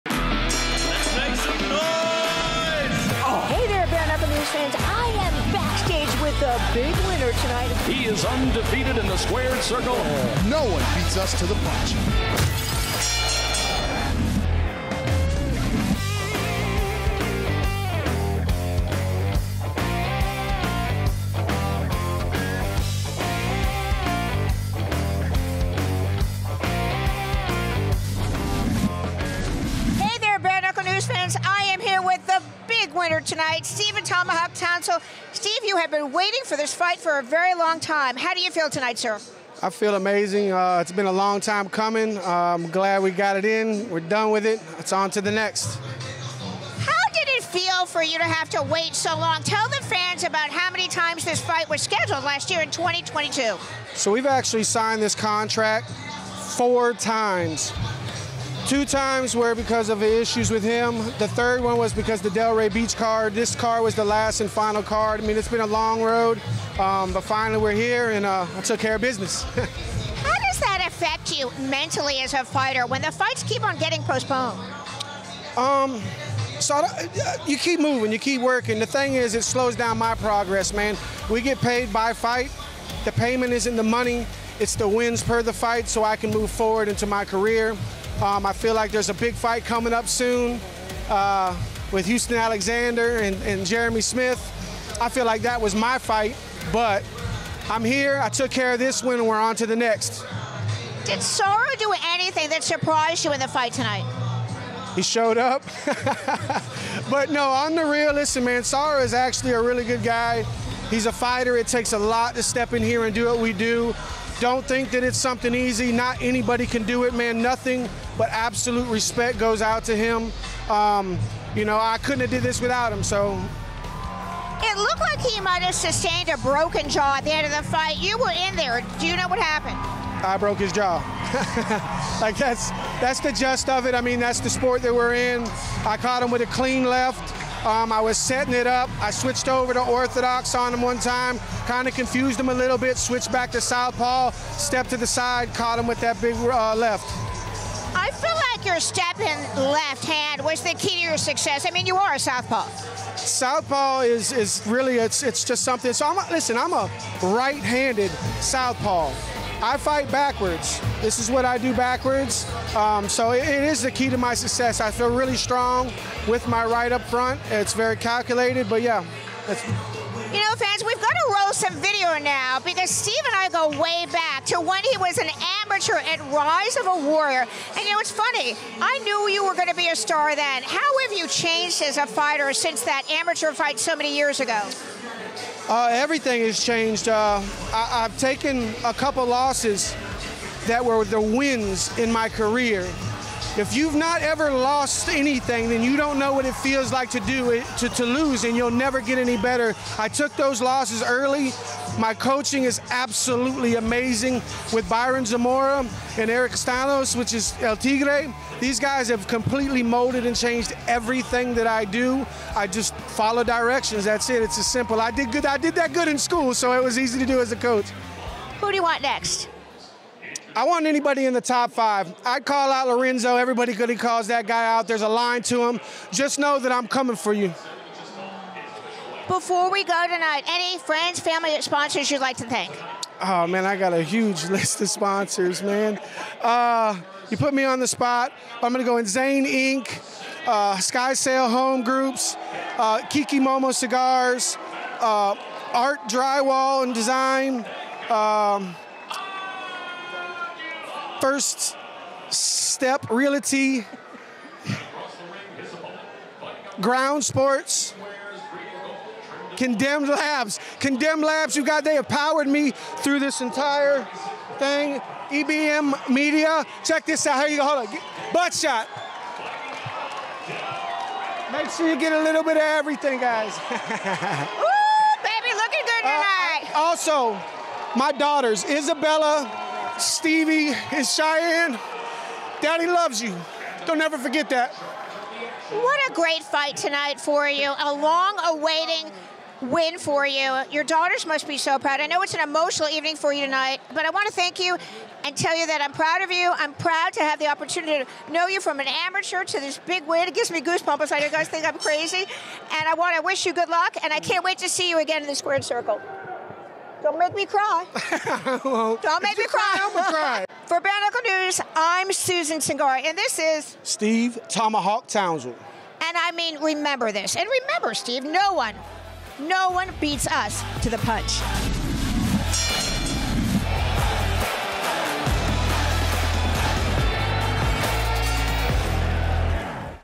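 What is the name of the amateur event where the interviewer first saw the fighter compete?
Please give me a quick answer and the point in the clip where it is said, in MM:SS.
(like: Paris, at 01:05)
Rise of a Warrior, at 02:56.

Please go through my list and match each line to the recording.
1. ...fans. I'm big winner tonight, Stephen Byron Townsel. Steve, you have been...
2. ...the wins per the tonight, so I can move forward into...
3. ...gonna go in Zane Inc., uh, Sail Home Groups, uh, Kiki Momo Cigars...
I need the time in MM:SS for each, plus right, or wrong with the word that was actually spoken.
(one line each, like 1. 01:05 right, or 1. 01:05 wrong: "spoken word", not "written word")
1. 00:31 wrong: "Tomahawk", not "Byron"
2. 01:24 wrong: "fight", not "tonight"
3. 03:58 right.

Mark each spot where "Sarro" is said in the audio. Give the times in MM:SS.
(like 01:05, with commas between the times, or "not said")
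01:41, 01:48.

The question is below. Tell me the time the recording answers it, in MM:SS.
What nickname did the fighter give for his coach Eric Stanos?
03:27.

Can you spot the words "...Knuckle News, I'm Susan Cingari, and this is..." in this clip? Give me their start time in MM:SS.
05:11.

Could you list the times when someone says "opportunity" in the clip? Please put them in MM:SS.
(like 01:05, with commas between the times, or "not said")
04:57.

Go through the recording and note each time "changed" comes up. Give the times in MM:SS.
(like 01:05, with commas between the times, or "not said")
03:01, 03:06, 03:30.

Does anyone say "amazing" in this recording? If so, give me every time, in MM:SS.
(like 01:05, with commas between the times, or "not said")
00:39, 03:23.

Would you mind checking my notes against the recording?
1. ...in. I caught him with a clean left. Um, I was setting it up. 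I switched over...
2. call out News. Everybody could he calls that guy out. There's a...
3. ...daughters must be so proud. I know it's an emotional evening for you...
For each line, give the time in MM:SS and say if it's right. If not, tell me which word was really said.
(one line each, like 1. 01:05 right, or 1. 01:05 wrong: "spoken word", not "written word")
1. 02:15 right
2. 03:42 wrong: "Lorenzo", not "News"
3. 04:50 right.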